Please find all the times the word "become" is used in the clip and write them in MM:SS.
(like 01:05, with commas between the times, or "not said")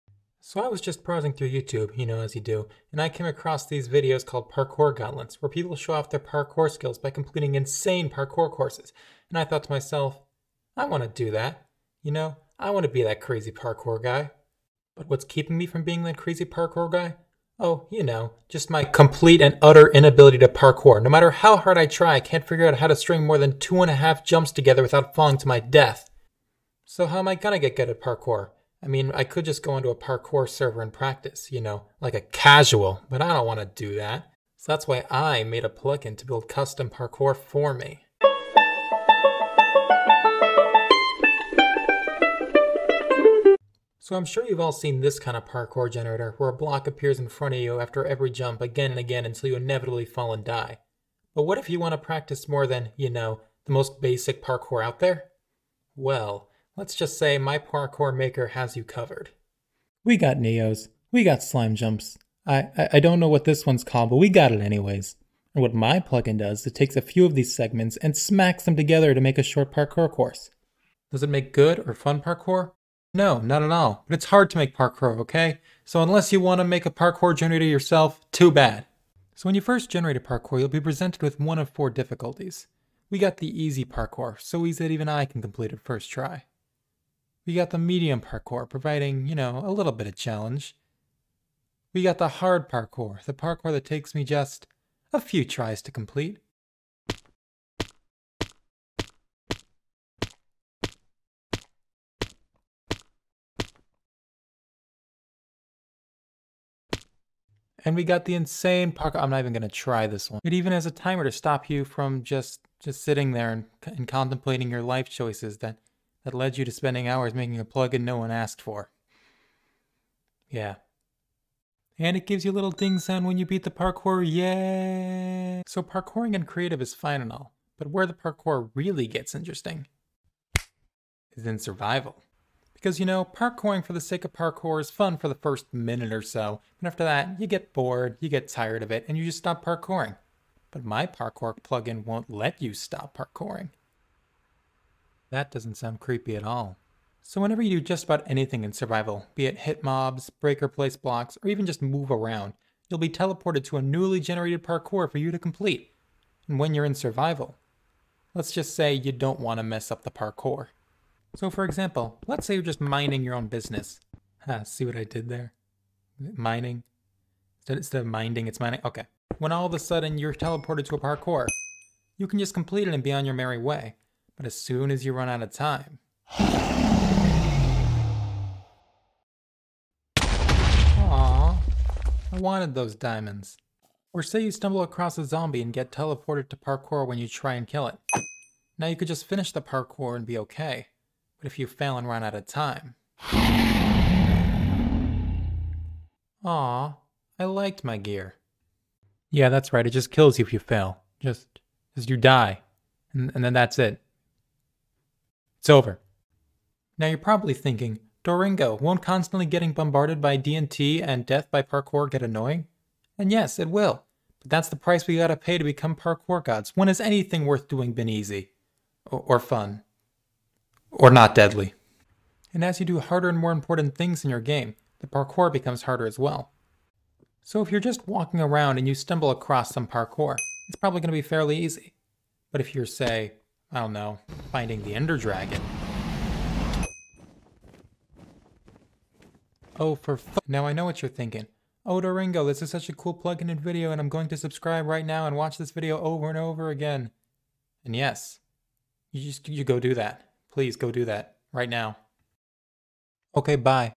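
03:35, 03:45.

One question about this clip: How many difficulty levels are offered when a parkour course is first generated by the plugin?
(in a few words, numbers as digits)
4.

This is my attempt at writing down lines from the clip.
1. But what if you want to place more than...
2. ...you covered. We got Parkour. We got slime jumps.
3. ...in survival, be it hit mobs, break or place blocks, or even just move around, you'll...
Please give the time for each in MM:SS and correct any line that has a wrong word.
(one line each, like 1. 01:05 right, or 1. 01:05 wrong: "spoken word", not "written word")
1. 00:51 wrong: "practice", not "place"
2. 00:58 wrong: "Neos", not "Parkour"
3. 02:28 right.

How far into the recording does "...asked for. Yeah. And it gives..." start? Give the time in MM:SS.
01:58.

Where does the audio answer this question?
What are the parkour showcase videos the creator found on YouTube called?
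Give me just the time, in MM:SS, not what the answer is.
00:04.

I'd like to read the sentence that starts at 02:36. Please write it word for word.
And when you're in survival, let's just say you don't want to mess up the parkour.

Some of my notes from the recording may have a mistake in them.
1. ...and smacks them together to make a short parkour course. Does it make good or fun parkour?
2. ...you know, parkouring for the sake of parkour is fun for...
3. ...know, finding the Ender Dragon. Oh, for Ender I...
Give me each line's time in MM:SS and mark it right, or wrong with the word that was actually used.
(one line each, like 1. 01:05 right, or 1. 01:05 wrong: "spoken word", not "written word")
1. 01:07 right
2. 02:12 right
3. 03:53 wrong: "Now", not "Ender".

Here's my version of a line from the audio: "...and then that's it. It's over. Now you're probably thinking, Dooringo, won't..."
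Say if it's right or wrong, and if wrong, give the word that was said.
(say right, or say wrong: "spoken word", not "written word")
right.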